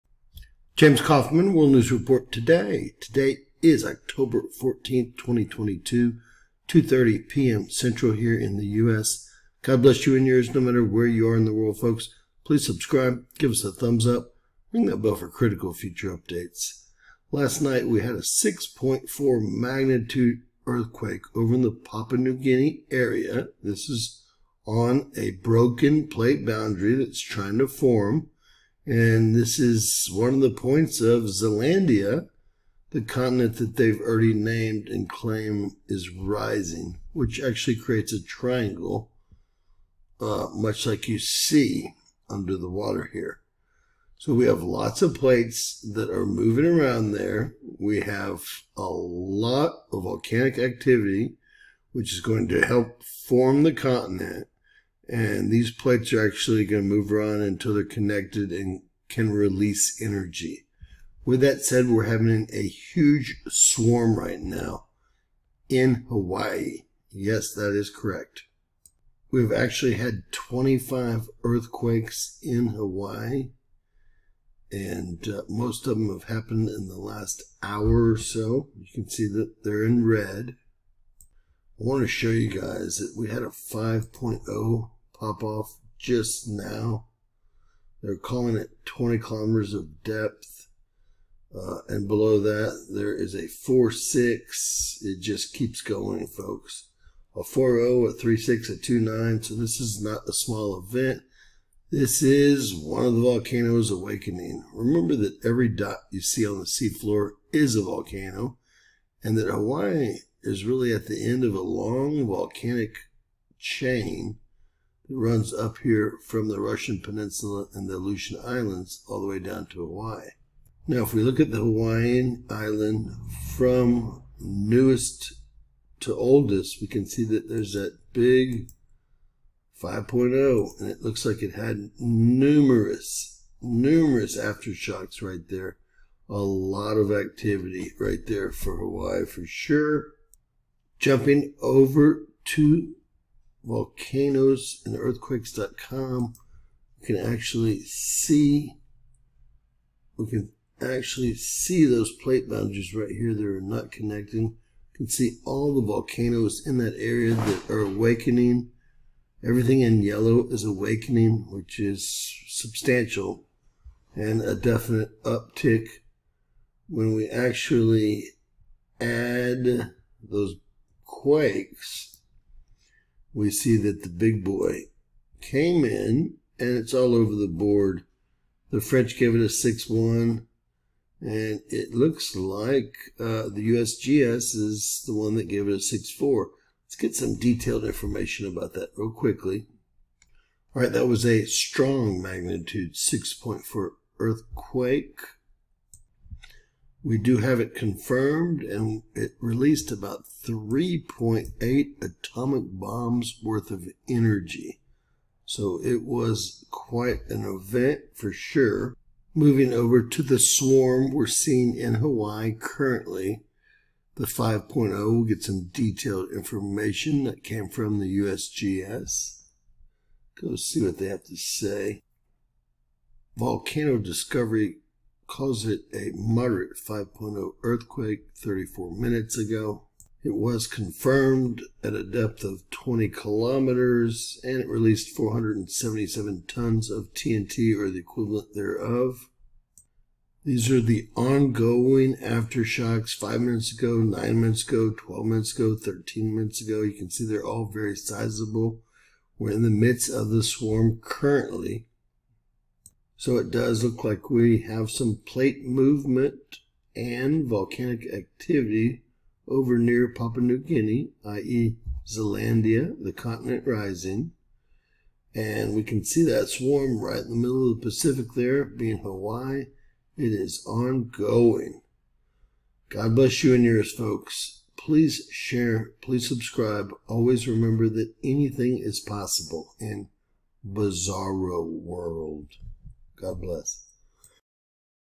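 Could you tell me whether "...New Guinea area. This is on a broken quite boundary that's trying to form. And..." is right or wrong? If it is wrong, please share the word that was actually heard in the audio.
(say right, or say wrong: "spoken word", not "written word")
wrong: "plate", not "quite".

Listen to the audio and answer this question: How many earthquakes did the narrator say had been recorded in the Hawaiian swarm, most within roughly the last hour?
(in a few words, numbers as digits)
25.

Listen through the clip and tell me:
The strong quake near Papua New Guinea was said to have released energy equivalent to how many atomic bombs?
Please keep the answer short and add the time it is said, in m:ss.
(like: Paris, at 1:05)
3.8, at 3:20.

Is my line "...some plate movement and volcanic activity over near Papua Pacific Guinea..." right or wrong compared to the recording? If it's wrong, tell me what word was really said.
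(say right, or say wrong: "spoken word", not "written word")
wrong: "New", not "Pacific".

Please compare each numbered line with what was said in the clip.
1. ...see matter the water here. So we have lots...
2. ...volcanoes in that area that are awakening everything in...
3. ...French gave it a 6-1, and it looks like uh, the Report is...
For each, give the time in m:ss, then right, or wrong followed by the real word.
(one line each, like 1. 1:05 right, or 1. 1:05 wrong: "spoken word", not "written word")
1. 0:41 wrong: "under", not "matter"
2. 2:35 right
3. 2:58 wrong: "USGS", not "Report".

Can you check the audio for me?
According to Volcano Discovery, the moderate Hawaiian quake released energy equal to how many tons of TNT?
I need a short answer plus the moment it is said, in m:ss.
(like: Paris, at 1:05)
477, at 3:55.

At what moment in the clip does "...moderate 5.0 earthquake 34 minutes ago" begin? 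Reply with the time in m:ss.
3:46.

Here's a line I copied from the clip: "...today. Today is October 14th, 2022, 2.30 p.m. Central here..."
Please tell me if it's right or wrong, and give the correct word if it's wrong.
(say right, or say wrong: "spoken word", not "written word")
right.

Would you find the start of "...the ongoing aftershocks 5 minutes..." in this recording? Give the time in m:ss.
4:00.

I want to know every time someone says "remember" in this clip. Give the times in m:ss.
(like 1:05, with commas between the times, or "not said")
1:44, 4:37.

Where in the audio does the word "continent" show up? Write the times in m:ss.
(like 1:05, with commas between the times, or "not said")
0:33, 0:53, 4:23.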